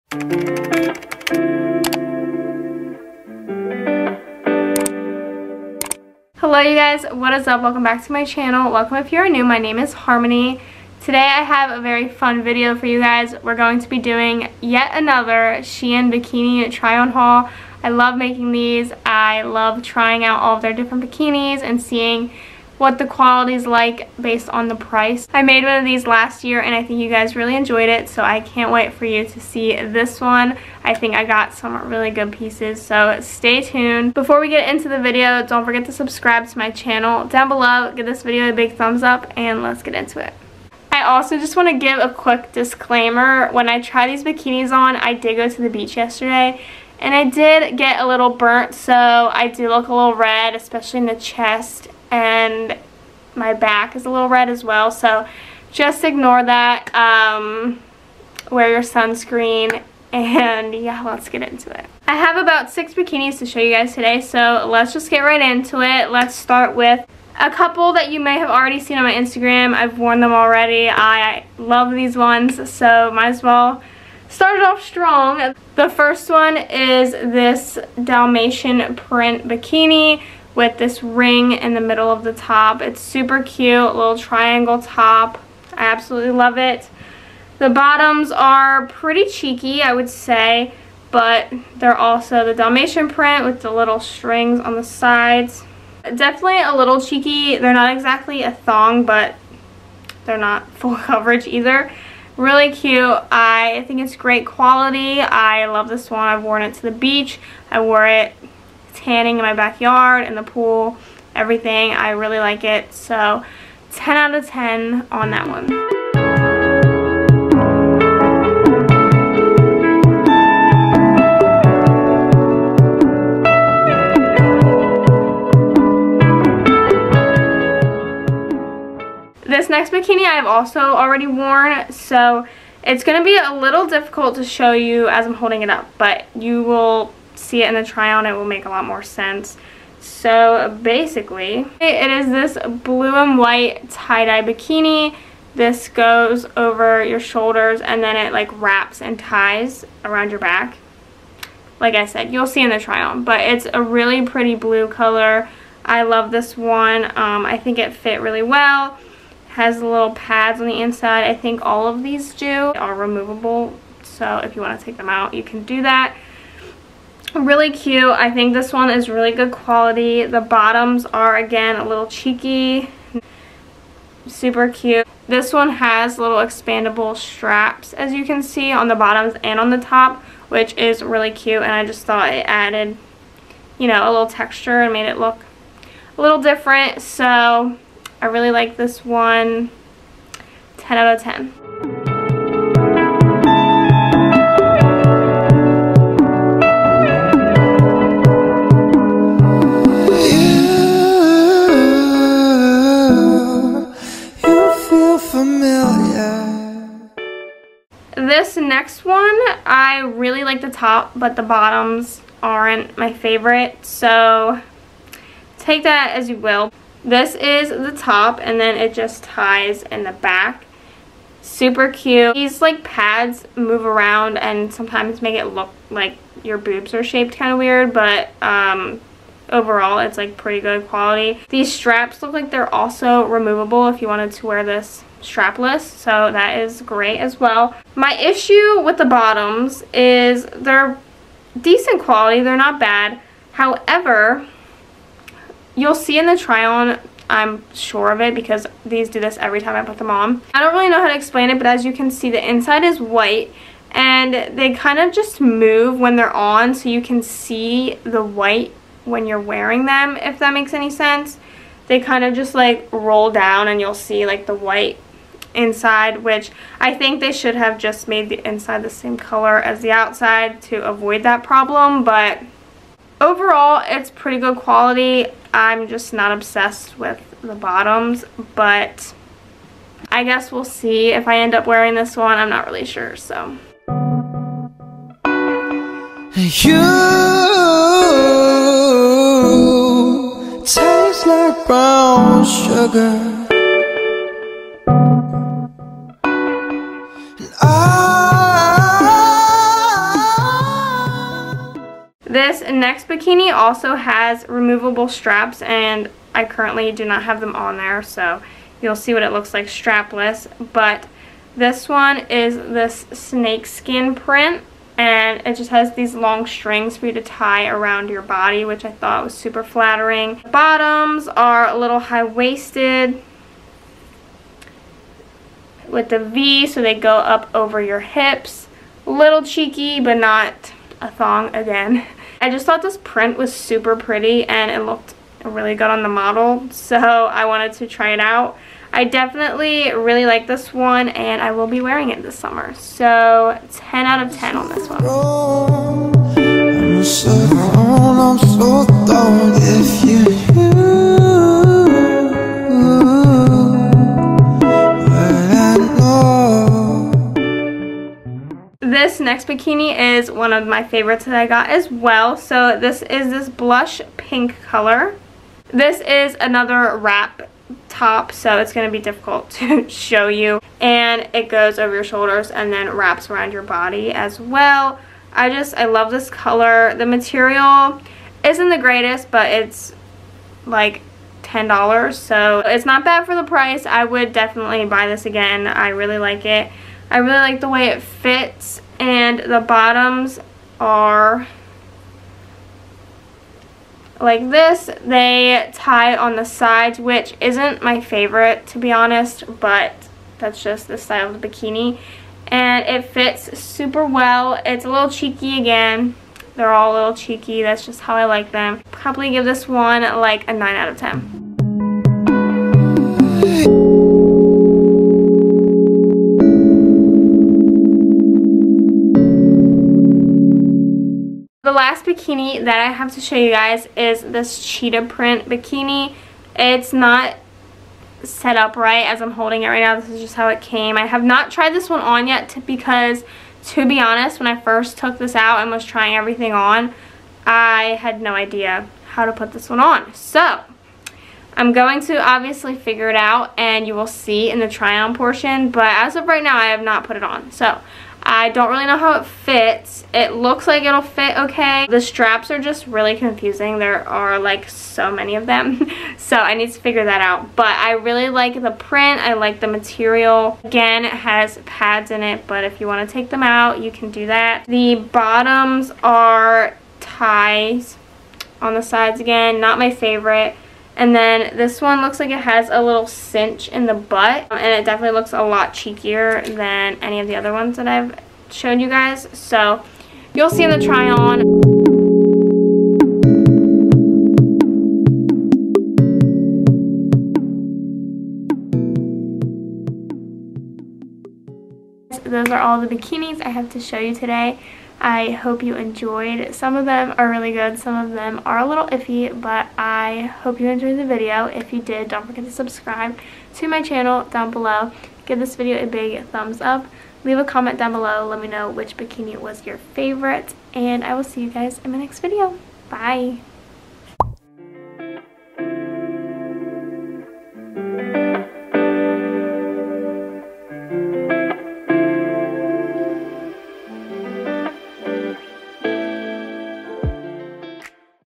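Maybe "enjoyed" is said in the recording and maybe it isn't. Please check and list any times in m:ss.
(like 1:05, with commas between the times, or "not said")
0:27, 8:15, 8:20.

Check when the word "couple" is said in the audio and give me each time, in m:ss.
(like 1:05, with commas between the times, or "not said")
1:07.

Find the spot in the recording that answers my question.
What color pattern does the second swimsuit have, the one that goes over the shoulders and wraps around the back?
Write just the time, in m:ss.
2:22.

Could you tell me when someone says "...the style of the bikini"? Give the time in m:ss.
6:40.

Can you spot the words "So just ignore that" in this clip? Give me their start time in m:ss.
0:54.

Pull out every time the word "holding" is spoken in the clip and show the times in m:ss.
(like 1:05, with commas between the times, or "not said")
2:15, 7:09.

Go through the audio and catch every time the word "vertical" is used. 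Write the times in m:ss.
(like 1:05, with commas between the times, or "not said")
not said.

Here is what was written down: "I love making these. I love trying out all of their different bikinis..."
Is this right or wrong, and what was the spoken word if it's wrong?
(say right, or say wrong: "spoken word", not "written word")
right.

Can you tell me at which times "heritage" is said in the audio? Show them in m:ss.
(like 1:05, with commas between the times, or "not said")
not said.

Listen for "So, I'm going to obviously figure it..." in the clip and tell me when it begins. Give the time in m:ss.
7:20.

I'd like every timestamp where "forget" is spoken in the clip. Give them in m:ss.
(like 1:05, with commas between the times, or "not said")
0:35, 8:22.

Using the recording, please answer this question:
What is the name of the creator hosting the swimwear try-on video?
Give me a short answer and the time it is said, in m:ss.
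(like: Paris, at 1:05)
Harmony, at 0:09.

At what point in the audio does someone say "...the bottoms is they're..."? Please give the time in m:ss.
3:58.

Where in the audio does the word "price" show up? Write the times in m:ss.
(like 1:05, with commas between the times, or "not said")
0:24, 6:23.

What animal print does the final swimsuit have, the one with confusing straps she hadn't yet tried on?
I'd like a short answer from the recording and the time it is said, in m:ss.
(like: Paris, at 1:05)
cheetah, at 7:04.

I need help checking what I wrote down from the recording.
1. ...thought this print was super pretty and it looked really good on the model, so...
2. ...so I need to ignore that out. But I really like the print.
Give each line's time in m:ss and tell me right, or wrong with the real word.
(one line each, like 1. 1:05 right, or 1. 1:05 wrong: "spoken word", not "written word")
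1. 5:32 right
2. 7:36 wrong: "figure", not "ignore".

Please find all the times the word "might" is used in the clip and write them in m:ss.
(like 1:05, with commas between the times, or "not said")
1:13.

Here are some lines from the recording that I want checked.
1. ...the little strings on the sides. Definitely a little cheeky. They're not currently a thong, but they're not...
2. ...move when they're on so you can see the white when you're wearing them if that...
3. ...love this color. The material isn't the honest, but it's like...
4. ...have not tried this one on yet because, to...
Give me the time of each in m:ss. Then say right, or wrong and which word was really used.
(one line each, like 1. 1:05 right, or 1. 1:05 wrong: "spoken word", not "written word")
1. 1:33 wrong: "exactly", not "currently"
2. 4:15 right
3. 6:15 wrong: "greatest", not "honest"
4. 7:11 right.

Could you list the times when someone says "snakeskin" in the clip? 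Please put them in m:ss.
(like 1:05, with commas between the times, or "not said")
5:13.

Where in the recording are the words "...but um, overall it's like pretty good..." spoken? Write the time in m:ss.
3:47.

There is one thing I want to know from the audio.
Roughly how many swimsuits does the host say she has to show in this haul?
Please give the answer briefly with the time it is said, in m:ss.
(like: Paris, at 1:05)
6, at 1:02.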